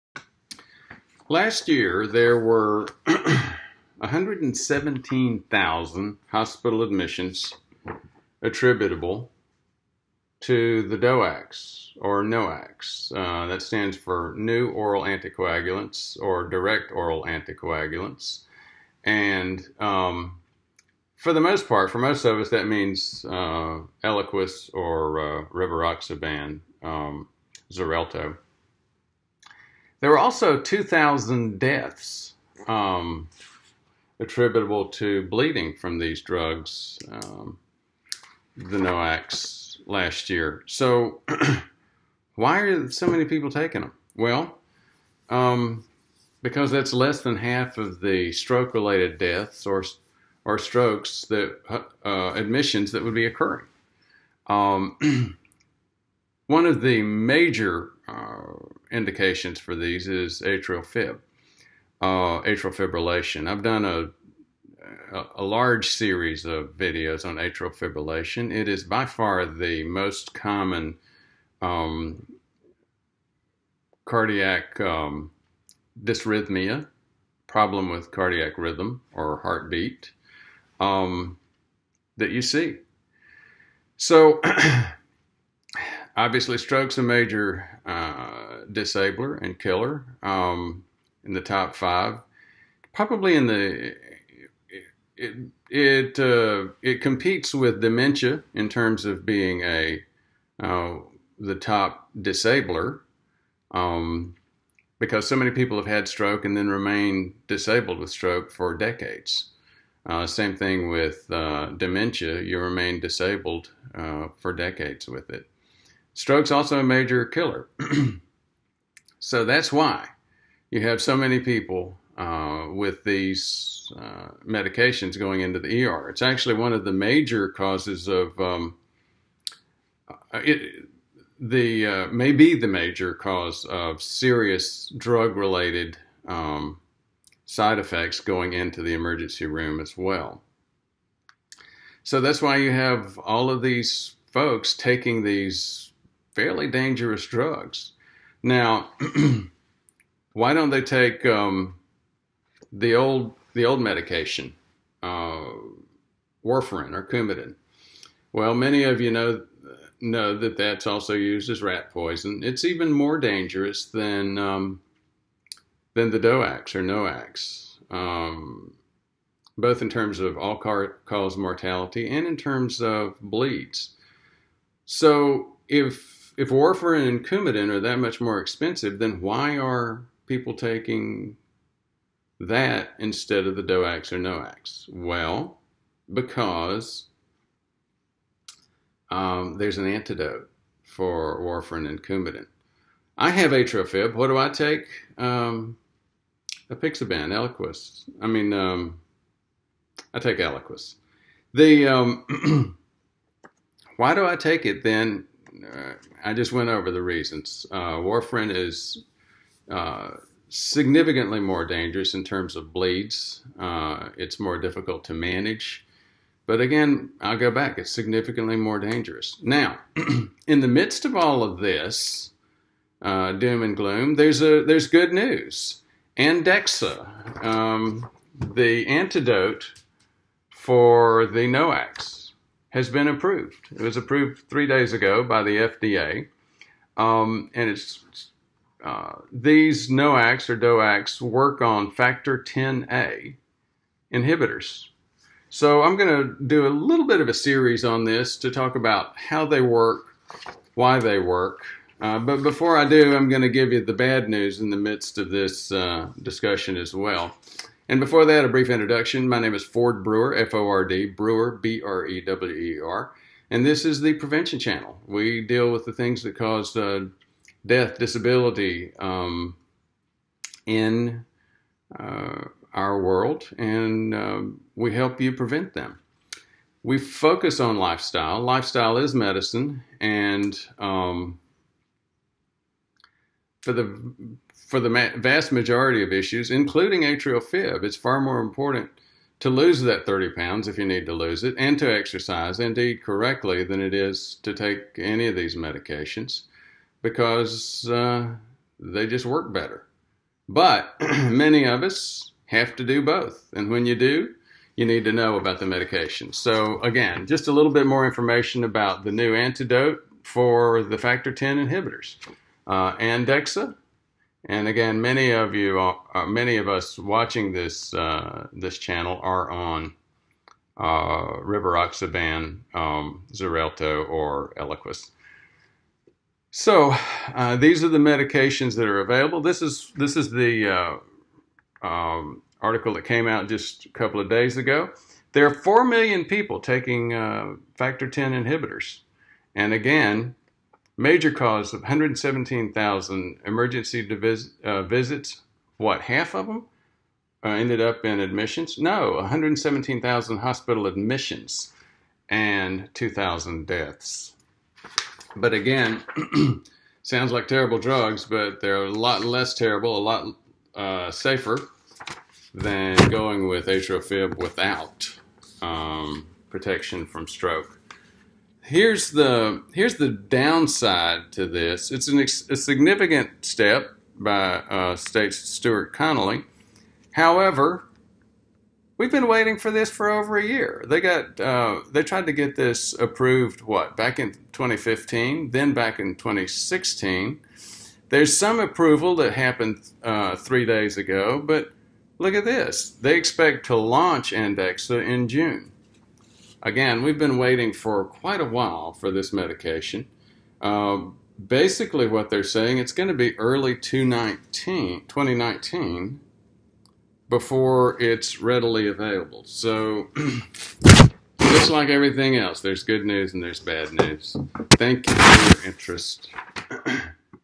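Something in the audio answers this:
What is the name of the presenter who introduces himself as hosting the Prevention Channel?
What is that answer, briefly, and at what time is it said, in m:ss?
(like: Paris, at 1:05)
Ford Brewer, at 4:19.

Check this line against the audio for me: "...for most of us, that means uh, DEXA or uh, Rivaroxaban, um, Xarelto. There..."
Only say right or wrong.
wrong.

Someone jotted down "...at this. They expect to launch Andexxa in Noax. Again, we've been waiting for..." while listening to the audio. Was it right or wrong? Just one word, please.
wrong.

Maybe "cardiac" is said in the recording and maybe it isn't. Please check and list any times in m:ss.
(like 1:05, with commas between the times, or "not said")
1:14, 1:18.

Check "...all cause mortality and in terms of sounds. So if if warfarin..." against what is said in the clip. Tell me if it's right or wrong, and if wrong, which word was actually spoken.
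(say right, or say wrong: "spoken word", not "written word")
wrong: "bleeds", not "sounds".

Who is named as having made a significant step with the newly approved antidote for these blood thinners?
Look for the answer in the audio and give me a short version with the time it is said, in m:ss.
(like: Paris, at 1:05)
Stuart Connolly, at 6:15.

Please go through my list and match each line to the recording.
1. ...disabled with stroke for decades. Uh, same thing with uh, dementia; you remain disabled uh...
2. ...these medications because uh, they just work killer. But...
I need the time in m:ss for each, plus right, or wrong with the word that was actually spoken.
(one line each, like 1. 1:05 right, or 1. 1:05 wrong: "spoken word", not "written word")
1. 1:47 right
2. 4:55 wrong: "better", not "killer".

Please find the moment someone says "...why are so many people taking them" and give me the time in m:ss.
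0:42.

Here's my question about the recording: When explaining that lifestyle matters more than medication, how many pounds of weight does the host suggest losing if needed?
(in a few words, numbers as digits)
30 pounds.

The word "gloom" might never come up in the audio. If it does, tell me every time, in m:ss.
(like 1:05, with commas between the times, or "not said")
3:43.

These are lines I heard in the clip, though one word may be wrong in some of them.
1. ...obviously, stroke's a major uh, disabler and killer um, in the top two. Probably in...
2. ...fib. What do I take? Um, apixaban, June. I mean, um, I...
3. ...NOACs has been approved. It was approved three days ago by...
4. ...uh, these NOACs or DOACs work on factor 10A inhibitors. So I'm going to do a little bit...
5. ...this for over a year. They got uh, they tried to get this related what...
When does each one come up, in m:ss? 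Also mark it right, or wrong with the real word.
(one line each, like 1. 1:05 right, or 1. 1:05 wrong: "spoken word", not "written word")
1. 1:26 wrong: "five", not "two"
2. 3:13 wrong: "Eliquis", not "June"
3. 3:51 right
4. 3:58 right
5. 6:19 wrong: "approved", not "related".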